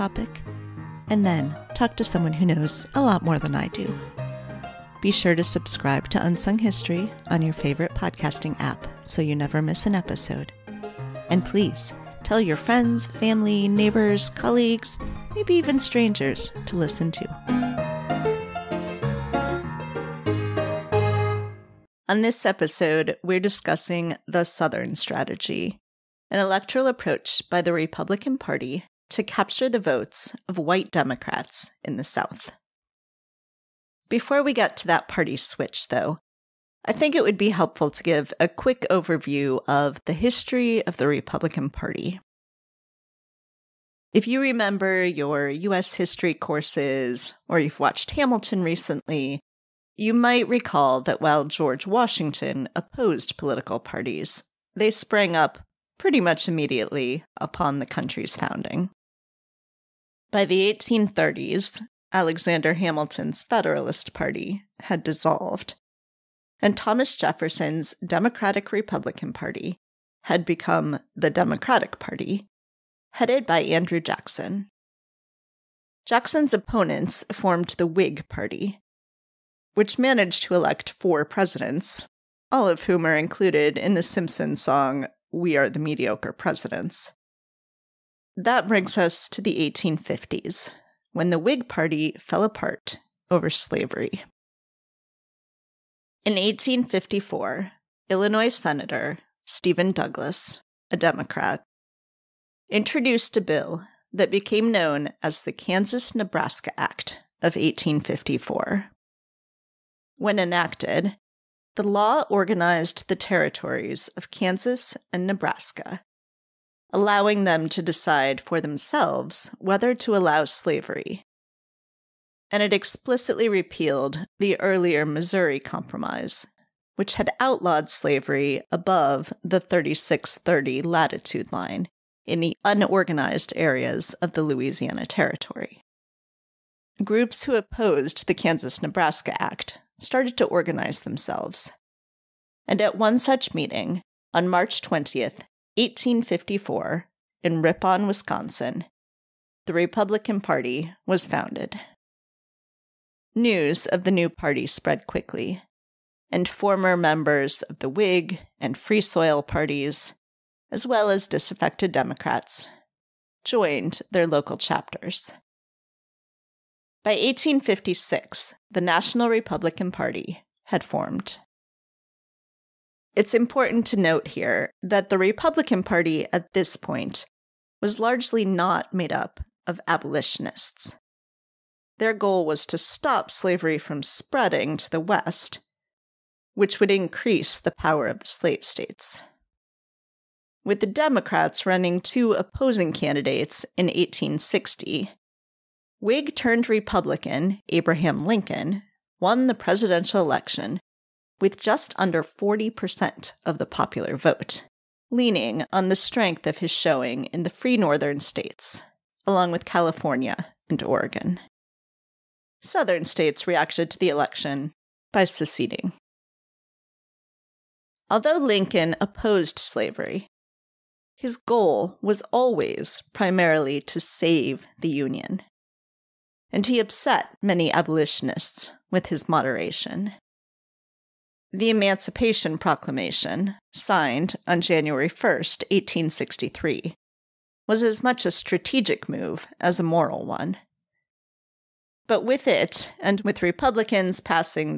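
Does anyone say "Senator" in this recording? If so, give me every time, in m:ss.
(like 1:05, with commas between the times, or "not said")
1:38.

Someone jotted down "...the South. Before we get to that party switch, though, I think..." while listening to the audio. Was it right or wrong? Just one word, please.
right.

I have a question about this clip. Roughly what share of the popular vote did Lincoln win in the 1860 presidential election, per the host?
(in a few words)
just under 40%.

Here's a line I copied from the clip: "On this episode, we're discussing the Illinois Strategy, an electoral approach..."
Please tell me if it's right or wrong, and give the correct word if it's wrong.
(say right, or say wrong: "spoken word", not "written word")
wrong: "Southern", not "Illinois".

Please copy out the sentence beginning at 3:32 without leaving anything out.
Southern states reacted to the election by seceding.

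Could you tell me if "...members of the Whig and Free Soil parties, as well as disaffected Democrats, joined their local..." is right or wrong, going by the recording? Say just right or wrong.
right.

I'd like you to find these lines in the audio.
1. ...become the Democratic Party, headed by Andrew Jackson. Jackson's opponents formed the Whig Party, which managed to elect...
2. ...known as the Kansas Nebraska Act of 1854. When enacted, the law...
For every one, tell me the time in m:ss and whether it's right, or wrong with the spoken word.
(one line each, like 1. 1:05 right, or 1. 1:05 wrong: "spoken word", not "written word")
1. 1:10 right
2. 1:44 right.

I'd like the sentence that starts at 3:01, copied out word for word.
Their goal was to stop slavery from spreading to the West, which would increase the power of the slave states.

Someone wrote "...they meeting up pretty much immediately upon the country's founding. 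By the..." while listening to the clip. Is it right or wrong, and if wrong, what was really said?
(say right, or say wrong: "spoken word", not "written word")
wrong: "sprang", not "meeting".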